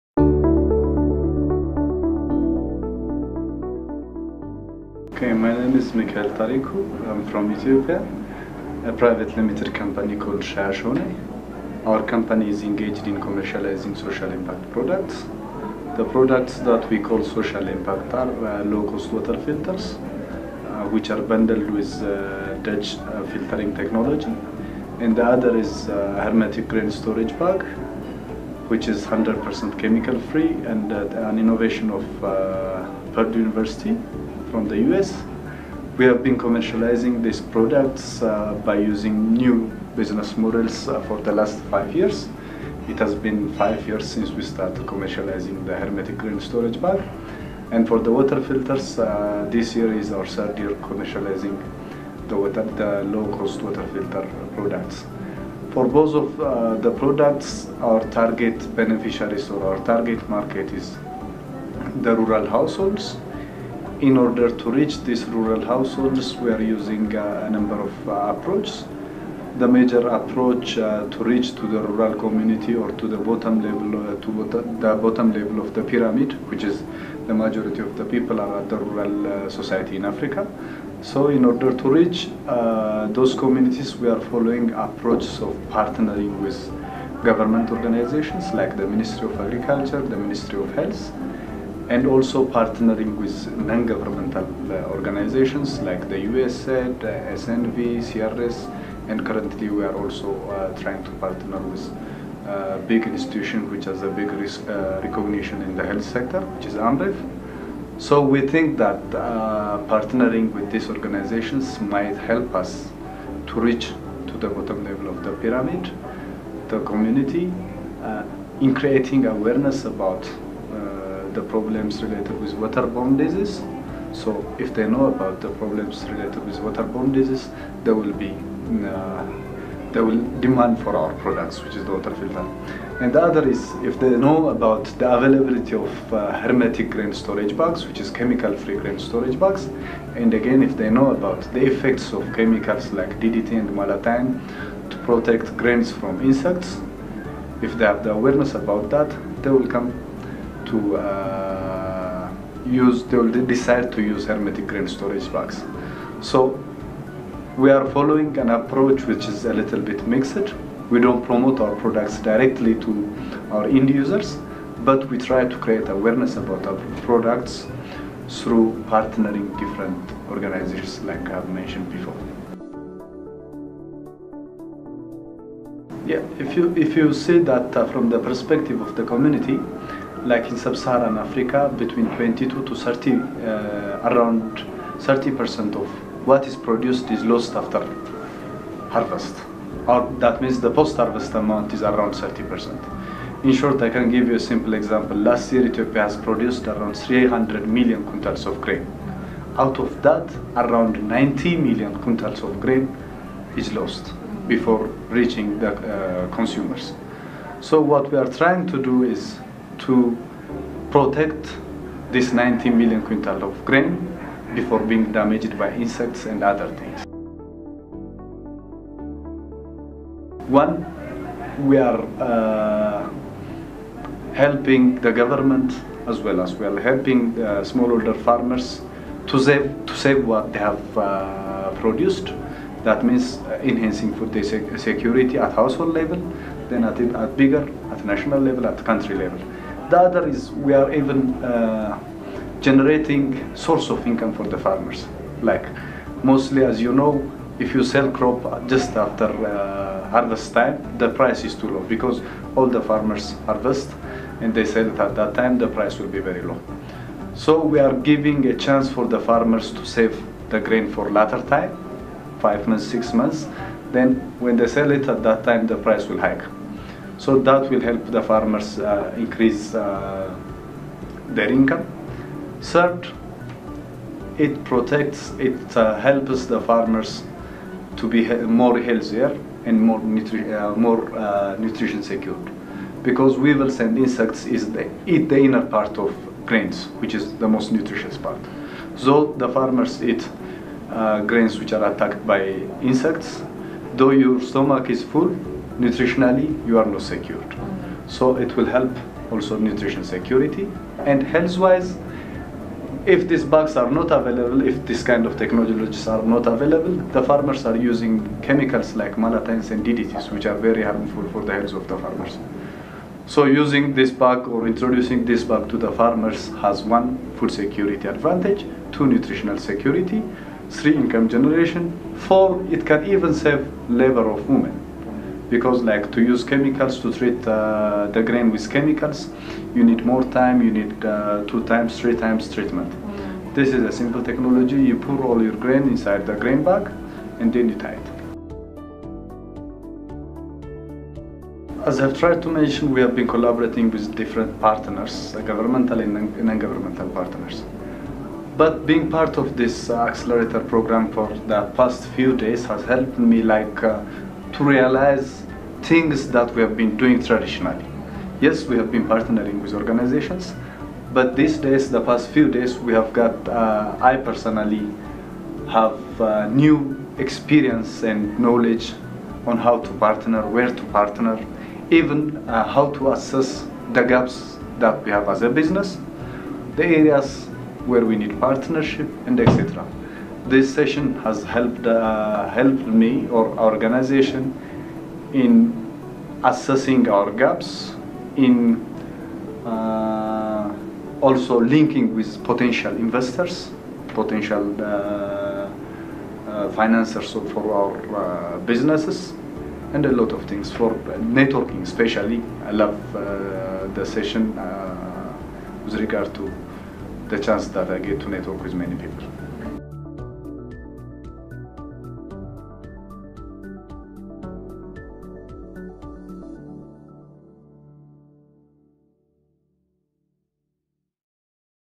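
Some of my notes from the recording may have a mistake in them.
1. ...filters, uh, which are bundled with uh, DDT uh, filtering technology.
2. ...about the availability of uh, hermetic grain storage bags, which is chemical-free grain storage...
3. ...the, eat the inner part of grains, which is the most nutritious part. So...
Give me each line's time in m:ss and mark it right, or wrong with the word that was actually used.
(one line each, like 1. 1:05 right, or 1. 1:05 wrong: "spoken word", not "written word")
1. 0:19 wrong: "Dutch", not "DDT"
2. 2:14 right
3. 4:44 right.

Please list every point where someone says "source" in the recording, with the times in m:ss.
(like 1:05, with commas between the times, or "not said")
4:03.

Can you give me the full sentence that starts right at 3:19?
Out of that, around 90 million quintals of grain is lost before reaching the uh, consumers.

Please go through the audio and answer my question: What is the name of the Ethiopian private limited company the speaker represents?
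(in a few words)
Shayashone.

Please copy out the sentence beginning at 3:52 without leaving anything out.
That means uh, enhancing food security at household level, then at, at bigger, at national level, at country level.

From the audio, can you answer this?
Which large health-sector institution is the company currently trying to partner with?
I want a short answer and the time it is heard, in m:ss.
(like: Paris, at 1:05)
Amref, at 1:46.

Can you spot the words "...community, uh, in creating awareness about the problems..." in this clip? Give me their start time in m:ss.
1:56.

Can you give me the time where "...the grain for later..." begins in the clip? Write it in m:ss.
4:20.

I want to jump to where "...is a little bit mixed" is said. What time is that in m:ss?
2:39.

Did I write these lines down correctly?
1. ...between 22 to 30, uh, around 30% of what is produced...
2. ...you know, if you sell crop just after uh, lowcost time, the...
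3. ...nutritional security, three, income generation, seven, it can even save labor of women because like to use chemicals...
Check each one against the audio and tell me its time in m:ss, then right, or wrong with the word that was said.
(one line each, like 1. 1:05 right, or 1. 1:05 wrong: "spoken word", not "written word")
1. 3:01 right
2. 4:06 wrong: "harvest", not "lowcost"
3. 5:19 wrong: "four", not "seven".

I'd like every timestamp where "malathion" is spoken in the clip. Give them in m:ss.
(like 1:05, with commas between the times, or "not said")
2:23, 5:09.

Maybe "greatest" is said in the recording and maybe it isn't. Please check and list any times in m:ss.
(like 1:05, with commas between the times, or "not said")
not said.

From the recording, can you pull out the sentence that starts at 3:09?
Or that means the post-harvest amount is around 30%.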